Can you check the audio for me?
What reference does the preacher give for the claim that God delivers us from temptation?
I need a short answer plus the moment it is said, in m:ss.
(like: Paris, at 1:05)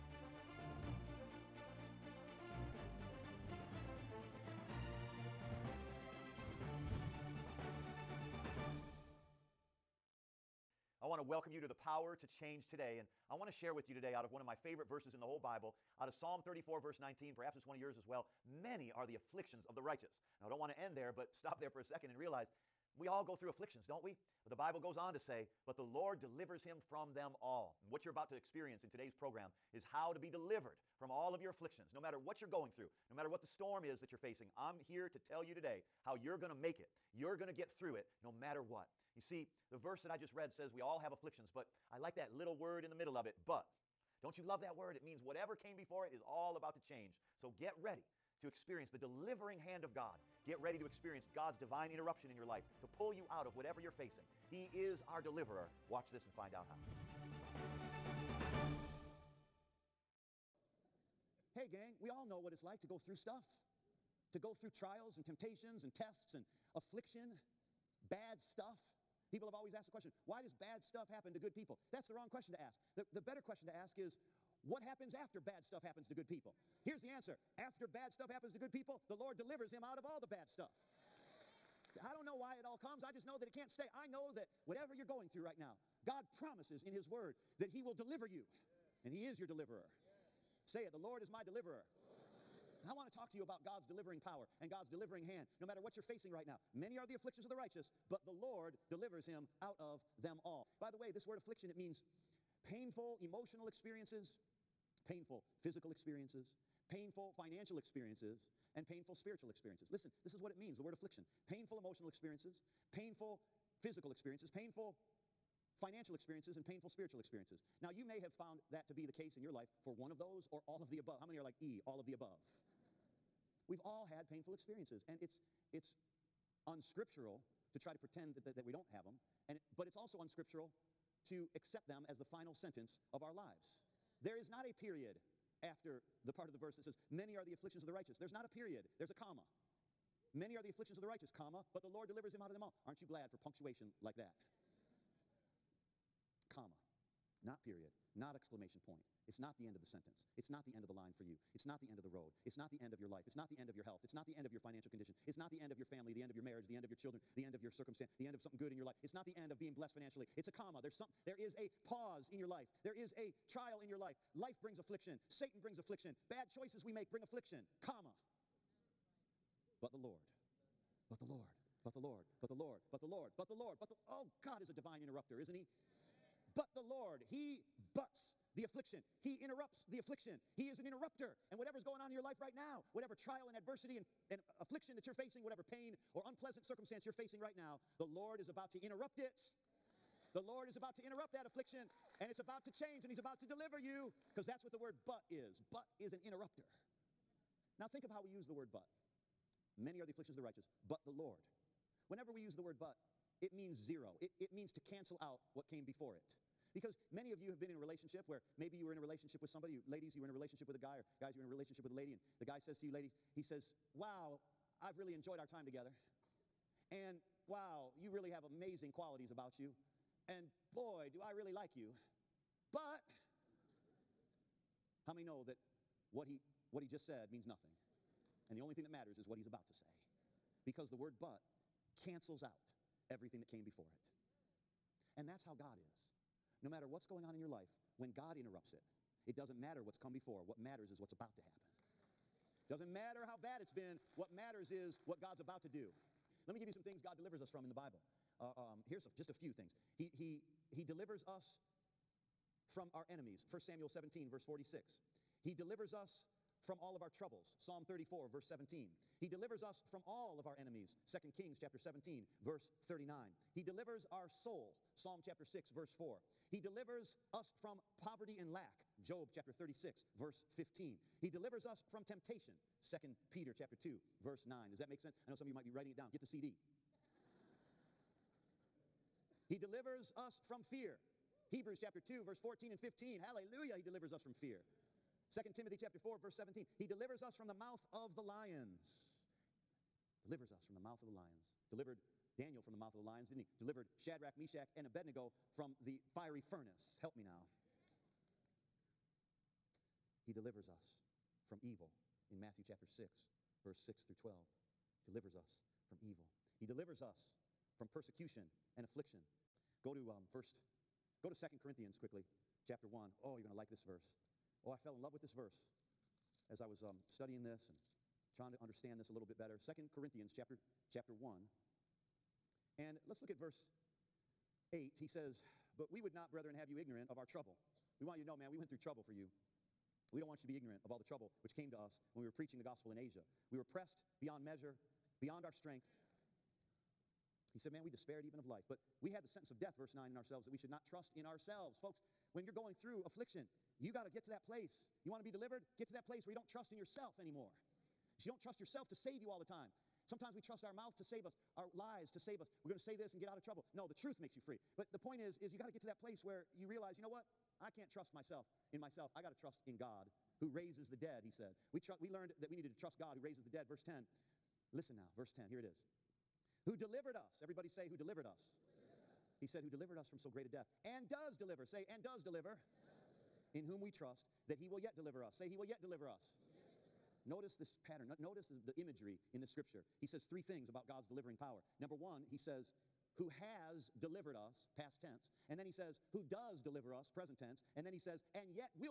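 2 Peter 2:9, at 4:32.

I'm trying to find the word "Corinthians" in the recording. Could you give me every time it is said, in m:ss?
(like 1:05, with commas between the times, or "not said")
5:11, 5:19.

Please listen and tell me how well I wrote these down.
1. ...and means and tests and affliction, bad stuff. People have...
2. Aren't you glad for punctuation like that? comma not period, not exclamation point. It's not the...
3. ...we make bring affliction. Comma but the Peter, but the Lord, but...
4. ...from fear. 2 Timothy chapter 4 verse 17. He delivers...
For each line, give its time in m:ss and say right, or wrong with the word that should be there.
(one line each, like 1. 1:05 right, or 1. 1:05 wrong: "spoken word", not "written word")
1. 1:05 wrong: "temptations", not "means"
2. 2:22 right
3. 2:46 wrong: "Lord", not "Peter"
4. 4:44 right.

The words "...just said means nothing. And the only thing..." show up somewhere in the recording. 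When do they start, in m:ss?
3:46.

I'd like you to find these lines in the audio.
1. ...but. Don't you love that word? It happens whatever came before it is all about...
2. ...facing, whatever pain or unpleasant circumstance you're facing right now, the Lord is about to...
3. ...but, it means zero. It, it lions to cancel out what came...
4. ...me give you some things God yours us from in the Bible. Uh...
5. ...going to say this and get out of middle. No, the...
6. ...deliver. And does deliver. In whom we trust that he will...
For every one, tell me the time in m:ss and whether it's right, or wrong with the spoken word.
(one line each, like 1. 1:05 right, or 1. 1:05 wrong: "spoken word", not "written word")
1. 0:43 wrong: "means", not "happens"
2. 3:05 right
3. 3:22 wrong: "means", not "lions"
4. 4:06 wrong: "delivers", not "yours"
5. 5:52 wrong: "trouble", not "middle"
6. 6:12 right.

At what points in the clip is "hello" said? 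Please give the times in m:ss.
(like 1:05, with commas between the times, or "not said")
not said.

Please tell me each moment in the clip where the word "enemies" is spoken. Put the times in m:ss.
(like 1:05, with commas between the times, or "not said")
4:13, 4:20.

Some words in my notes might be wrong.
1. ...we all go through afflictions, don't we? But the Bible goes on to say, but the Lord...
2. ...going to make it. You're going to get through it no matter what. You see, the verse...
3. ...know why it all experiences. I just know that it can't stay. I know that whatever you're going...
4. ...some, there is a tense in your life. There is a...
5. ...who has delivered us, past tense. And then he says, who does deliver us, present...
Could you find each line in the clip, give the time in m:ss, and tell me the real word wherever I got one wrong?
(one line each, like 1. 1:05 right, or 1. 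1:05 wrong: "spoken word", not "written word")
1. 0:22 right
2. 0:36 right
3. 1:22 wrong: "comes", not "experiences"
4. 2:40 wrong: "pause", not "tense"
5. 6:23 right.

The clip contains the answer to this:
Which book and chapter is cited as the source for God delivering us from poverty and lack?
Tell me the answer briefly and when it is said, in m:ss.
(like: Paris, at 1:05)
Job 36:15, at 4:29.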